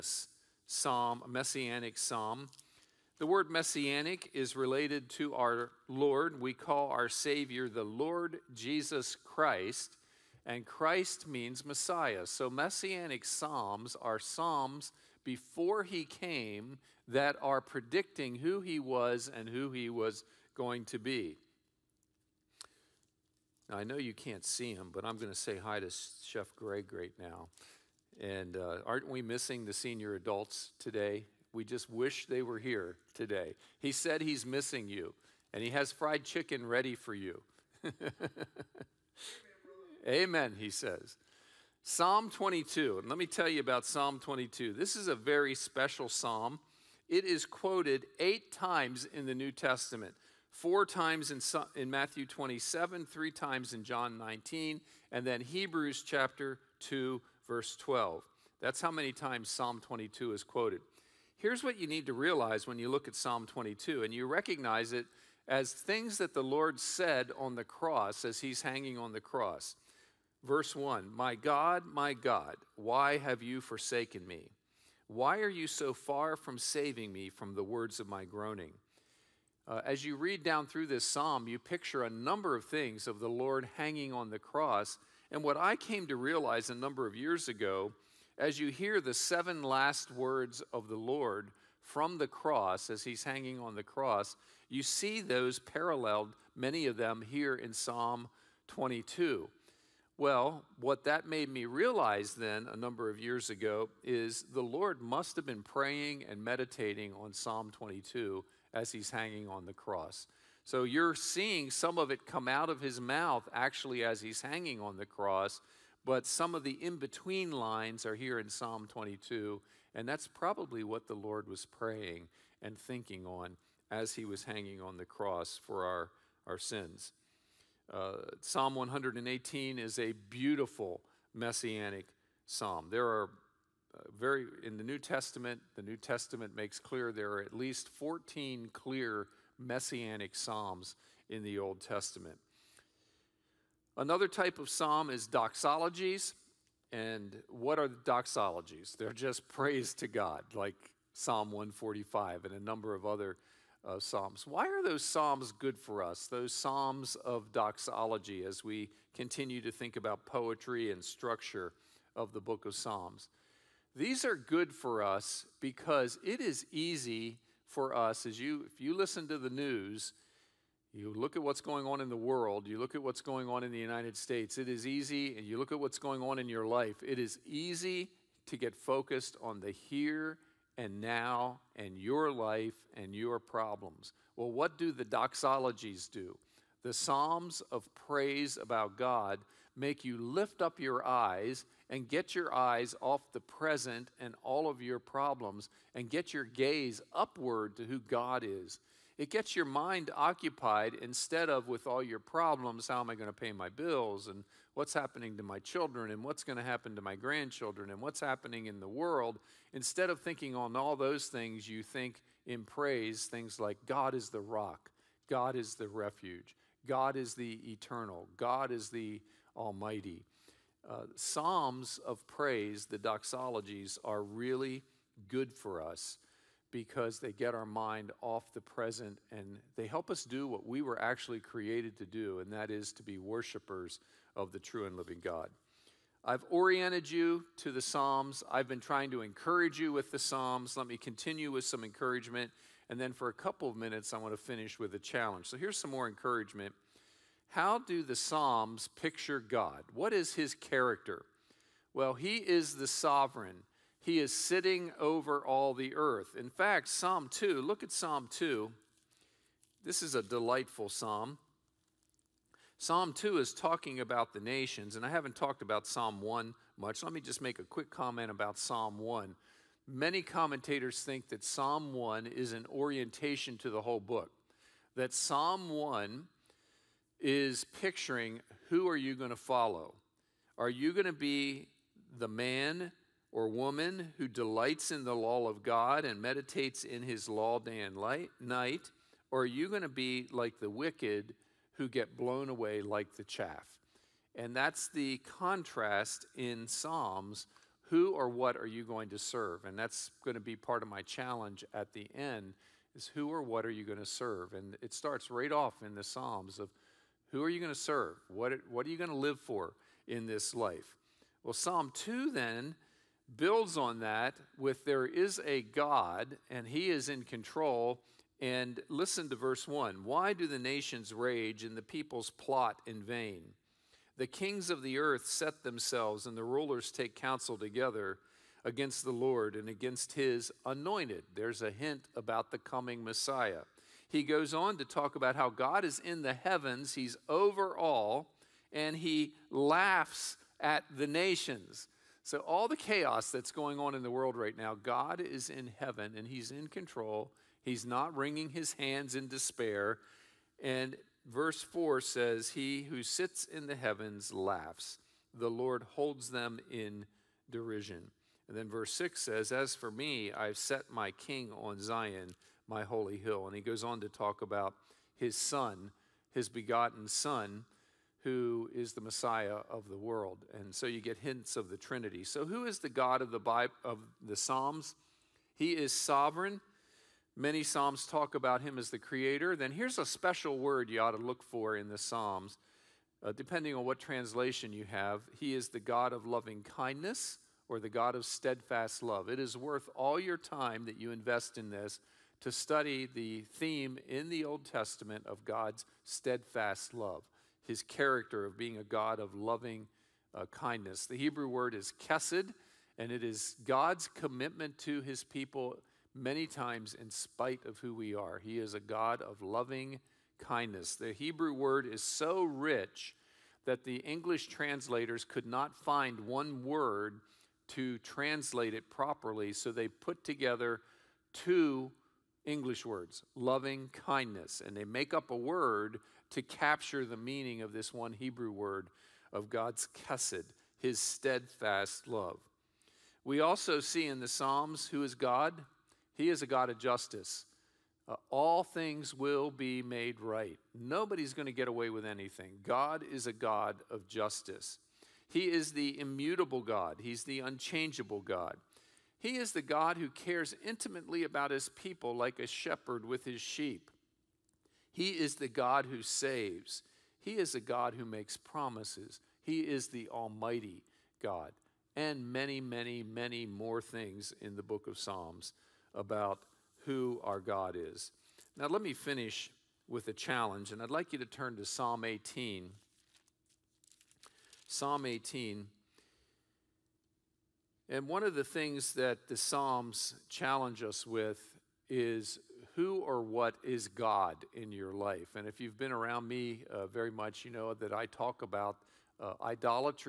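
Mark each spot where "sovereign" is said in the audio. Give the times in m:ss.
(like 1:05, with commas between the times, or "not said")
4:12, 6:15.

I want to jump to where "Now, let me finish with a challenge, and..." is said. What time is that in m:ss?
7:48.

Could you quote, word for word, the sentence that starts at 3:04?
Well, what do the doxologies do?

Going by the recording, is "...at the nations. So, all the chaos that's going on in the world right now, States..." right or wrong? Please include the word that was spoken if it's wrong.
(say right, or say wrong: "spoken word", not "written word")
wrong: "God", not "States".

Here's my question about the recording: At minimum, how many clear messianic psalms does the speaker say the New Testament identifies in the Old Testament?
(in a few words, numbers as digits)
14.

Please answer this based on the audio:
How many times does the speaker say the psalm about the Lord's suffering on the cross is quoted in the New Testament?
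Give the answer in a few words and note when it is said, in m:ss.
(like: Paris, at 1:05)
8, at 0:48.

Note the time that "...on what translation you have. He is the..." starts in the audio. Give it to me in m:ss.
6:23.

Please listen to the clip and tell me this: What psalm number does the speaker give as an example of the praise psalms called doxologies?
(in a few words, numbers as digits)
Psalm 145.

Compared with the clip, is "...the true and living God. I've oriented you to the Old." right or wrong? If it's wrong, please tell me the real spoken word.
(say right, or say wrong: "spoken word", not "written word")
wrong: "Psalms", not "Old".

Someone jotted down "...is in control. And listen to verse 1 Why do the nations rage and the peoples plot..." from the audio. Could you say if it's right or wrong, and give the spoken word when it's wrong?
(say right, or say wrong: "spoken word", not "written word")
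right.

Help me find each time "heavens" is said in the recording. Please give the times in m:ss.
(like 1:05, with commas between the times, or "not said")
5:36, 5:45, 5:53.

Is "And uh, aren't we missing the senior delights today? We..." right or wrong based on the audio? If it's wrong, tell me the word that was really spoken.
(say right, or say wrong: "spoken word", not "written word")
wrong: "adults", not "delights".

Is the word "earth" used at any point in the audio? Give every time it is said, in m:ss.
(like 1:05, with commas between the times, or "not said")
4:15, 5:24.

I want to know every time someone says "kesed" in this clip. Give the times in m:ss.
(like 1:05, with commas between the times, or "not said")
6:42, 7:10.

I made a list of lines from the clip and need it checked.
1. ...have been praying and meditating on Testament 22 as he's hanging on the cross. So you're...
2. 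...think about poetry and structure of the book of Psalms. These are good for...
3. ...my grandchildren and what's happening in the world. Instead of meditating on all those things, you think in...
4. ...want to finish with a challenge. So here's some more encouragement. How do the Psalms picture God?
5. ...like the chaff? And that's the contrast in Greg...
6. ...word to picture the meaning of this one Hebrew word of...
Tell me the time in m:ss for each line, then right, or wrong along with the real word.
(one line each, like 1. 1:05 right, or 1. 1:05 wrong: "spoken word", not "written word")
1. 1:45 wrong: "Psalm", not "Testament"
2. 2:39 right
3. 3:27 wrong: "thinking", not "meditating"
4. 4:04 right
5. 4:52 wrong: "Psalms", not "Greg"
6. 7:05 wrong: "capture", not "picture".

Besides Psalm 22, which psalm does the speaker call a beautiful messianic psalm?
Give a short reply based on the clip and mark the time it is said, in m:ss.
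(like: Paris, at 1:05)
Psalm 118, at 2:08.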